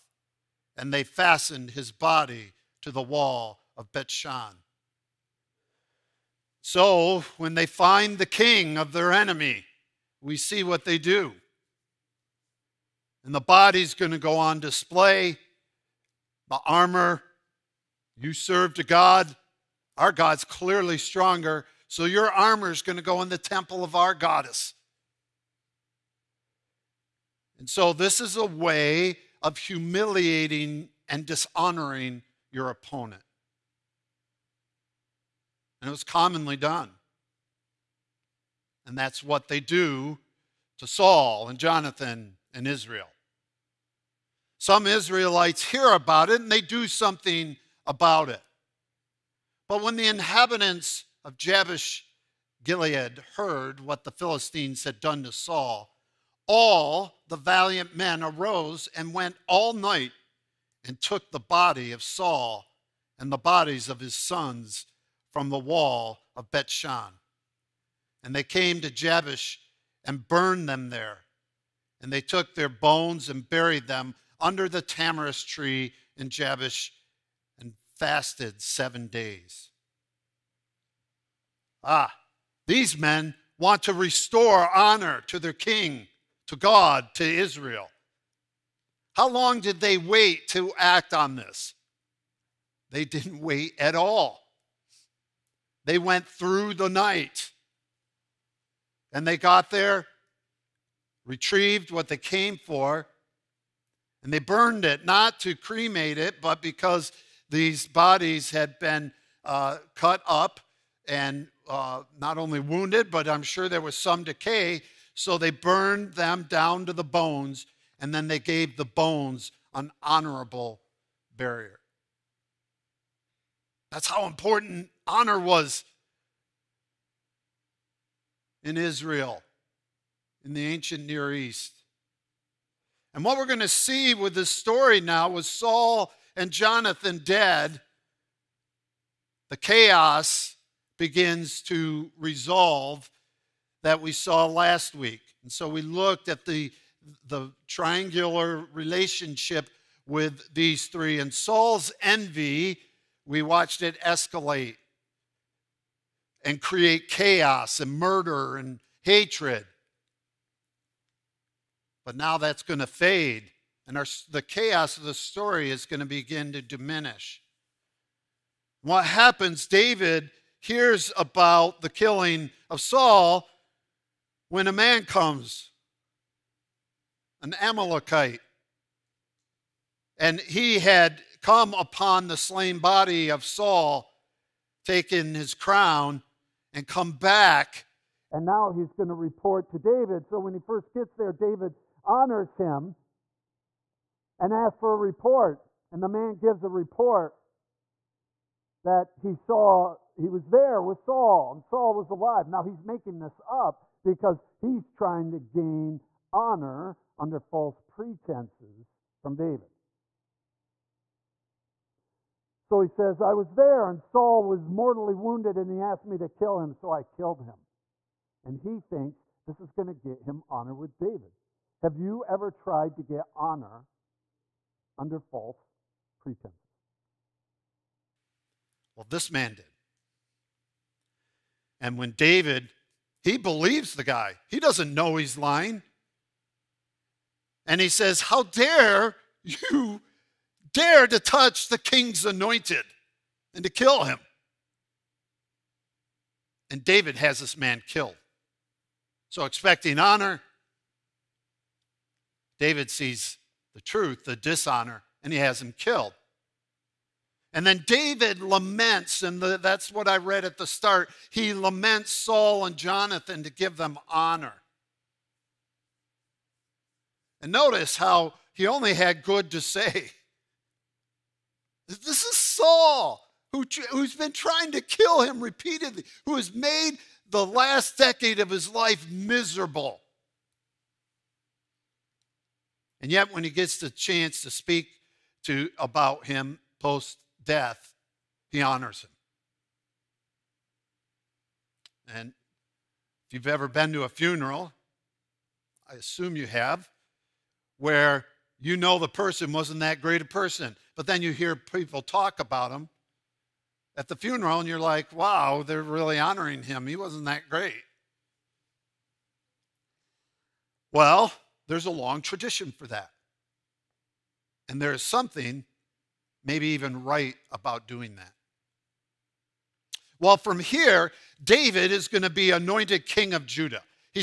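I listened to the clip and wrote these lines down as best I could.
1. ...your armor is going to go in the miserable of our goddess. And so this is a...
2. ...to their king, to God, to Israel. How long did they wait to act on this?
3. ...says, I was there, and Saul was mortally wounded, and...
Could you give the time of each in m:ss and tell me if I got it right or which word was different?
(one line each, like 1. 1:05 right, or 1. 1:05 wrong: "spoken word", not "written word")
1. 0:22 wrong: "temple", not "miserable"
2. 1:25 right
3. 3:32 right.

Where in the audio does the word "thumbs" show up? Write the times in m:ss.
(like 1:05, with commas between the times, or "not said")
not said.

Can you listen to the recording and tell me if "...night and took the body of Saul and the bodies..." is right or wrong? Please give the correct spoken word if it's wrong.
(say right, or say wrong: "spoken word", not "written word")
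right.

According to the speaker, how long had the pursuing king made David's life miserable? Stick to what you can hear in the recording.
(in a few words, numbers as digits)
The last decade.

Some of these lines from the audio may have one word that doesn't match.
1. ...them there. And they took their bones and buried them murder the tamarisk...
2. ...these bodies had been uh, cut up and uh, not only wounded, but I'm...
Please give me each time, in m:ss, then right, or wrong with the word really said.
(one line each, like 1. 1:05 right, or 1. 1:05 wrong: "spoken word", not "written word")
1. 1:10 wrong: "under", not "murder"
2. 1:47 right.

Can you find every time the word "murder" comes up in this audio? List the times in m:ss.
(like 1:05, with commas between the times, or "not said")
2:37.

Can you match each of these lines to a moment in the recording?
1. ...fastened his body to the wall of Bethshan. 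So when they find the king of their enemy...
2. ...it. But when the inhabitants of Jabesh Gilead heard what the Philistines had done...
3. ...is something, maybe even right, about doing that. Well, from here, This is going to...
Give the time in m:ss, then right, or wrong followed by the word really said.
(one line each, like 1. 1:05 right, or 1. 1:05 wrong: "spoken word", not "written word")
1. 0:01 right
2. 0:48 right
3. 5:14 wrong: "David", not "This".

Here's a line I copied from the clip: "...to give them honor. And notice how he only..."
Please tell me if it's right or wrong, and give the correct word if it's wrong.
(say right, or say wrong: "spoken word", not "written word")
right.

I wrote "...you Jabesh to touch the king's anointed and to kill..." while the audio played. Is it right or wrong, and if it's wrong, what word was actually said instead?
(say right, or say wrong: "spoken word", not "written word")
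wrong: "Dare", not "Jabesh".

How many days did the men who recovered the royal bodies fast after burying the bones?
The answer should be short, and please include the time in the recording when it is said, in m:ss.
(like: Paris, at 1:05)
7, at 1:18.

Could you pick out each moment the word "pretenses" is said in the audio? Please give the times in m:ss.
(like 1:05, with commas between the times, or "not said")
3:27, 3:46.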